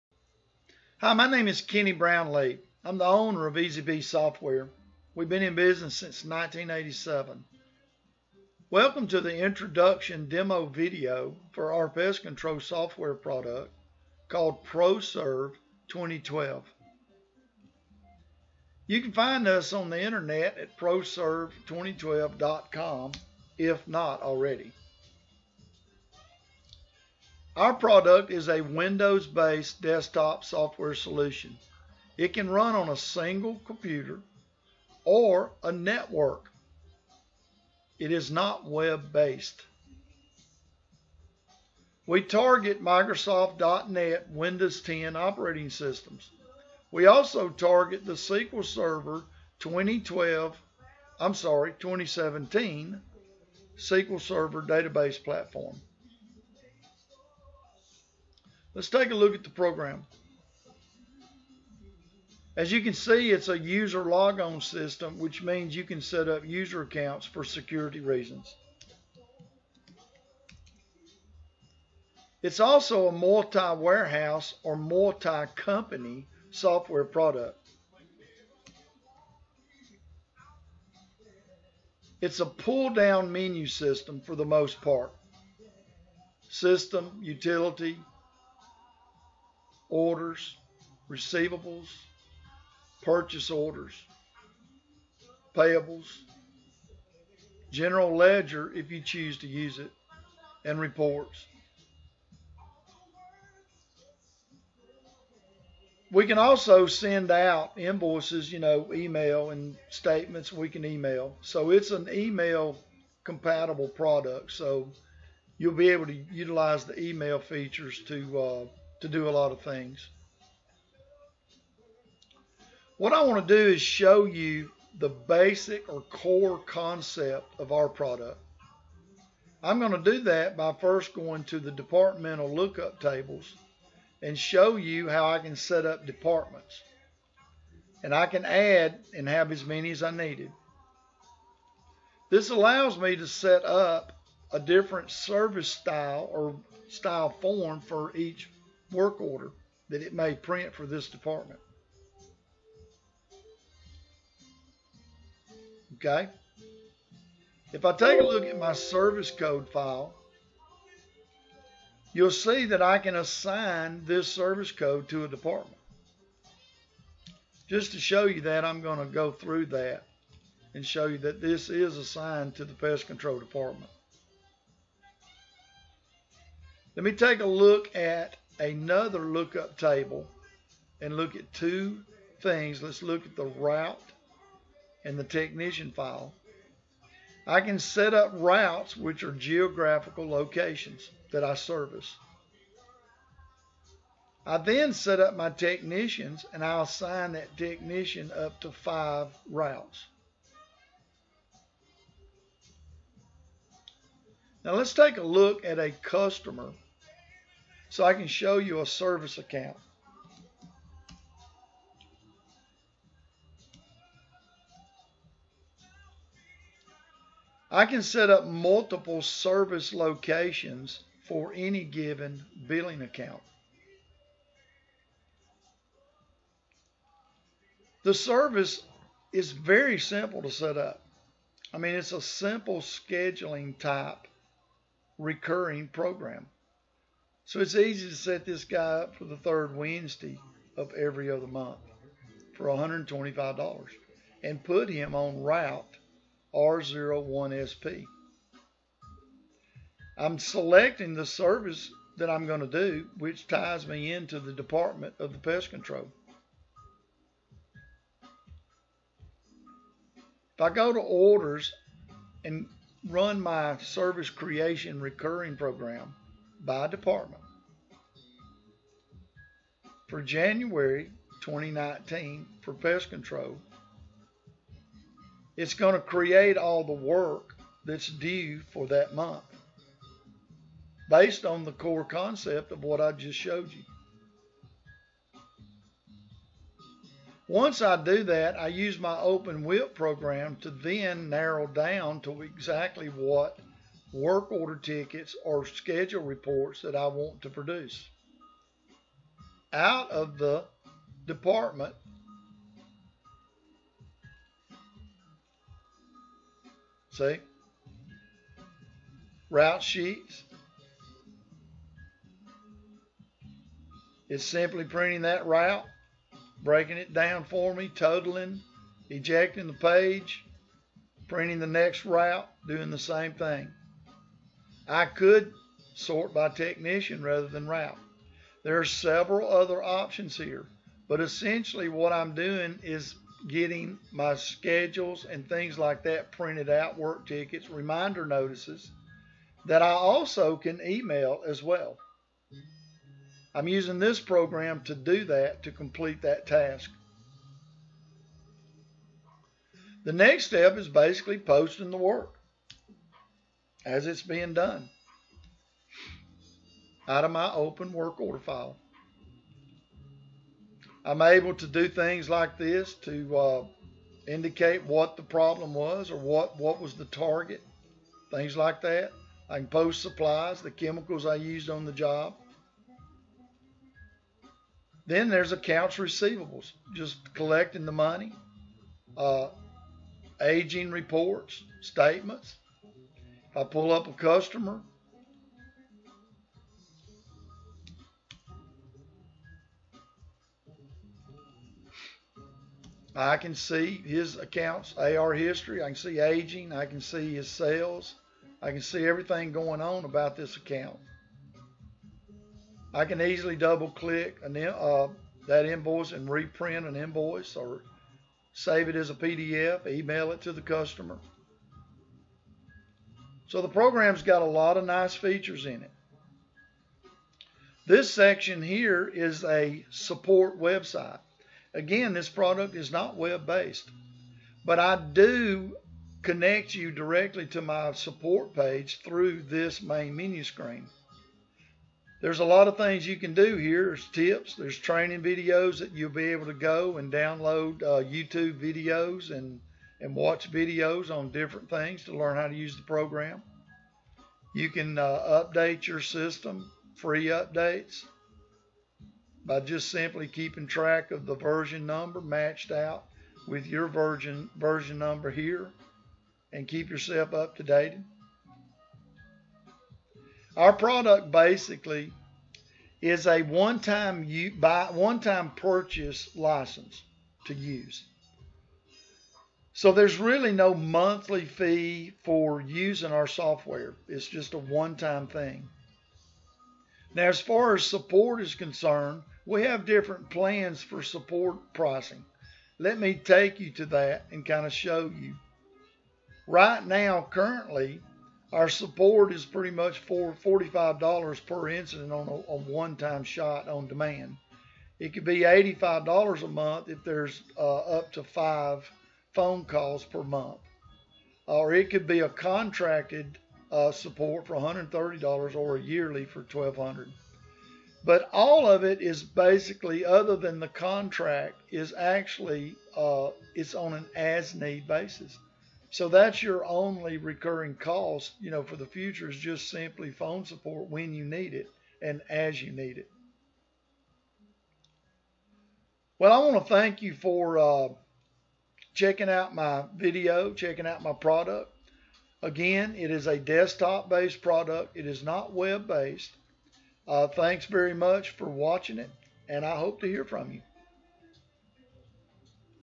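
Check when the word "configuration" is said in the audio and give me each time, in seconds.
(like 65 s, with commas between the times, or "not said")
not said.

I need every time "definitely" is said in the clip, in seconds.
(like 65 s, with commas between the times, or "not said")
not said.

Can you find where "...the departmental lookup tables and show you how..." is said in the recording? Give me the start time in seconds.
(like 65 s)
131 s.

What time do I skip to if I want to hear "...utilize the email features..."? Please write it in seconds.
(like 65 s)
116 s.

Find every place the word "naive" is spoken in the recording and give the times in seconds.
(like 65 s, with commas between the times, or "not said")
not said.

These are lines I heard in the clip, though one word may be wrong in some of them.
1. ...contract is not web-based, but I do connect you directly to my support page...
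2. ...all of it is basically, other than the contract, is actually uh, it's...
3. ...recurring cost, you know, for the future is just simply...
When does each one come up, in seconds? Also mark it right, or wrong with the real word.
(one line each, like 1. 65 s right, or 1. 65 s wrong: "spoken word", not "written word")
1. 422 s wrong: "product", not "contract"
2. 508 s right
3. 517 s right.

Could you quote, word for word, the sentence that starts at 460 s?
Our product basically is a one-time one-time purchase license to use.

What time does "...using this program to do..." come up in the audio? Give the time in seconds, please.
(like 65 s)
343 s.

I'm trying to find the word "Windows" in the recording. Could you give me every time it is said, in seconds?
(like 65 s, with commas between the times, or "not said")
28 s, 44 s.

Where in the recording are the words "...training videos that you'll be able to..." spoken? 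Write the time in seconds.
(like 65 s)
434 s.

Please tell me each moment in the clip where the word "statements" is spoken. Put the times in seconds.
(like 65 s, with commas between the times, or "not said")
109 s, 381 s.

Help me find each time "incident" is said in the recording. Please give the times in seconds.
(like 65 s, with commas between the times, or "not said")
491 s.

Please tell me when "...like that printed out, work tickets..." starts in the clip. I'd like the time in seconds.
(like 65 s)
335 s.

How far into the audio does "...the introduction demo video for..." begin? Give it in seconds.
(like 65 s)
9 s.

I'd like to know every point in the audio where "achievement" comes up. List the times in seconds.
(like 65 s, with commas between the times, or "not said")
not said.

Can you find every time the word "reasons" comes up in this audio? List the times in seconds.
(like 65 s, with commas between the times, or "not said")
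68 s.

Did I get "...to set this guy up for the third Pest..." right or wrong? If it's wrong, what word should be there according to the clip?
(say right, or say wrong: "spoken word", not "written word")
wrong: "Wednesday", not "Pest".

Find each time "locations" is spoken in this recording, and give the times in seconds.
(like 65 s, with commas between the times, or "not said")
190 s, 219 s.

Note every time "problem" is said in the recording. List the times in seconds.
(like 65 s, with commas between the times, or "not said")
365 s.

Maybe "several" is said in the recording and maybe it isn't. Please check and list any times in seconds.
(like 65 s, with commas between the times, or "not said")
328 s.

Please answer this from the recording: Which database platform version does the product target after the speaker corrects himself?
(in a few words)
SQL Server 2017.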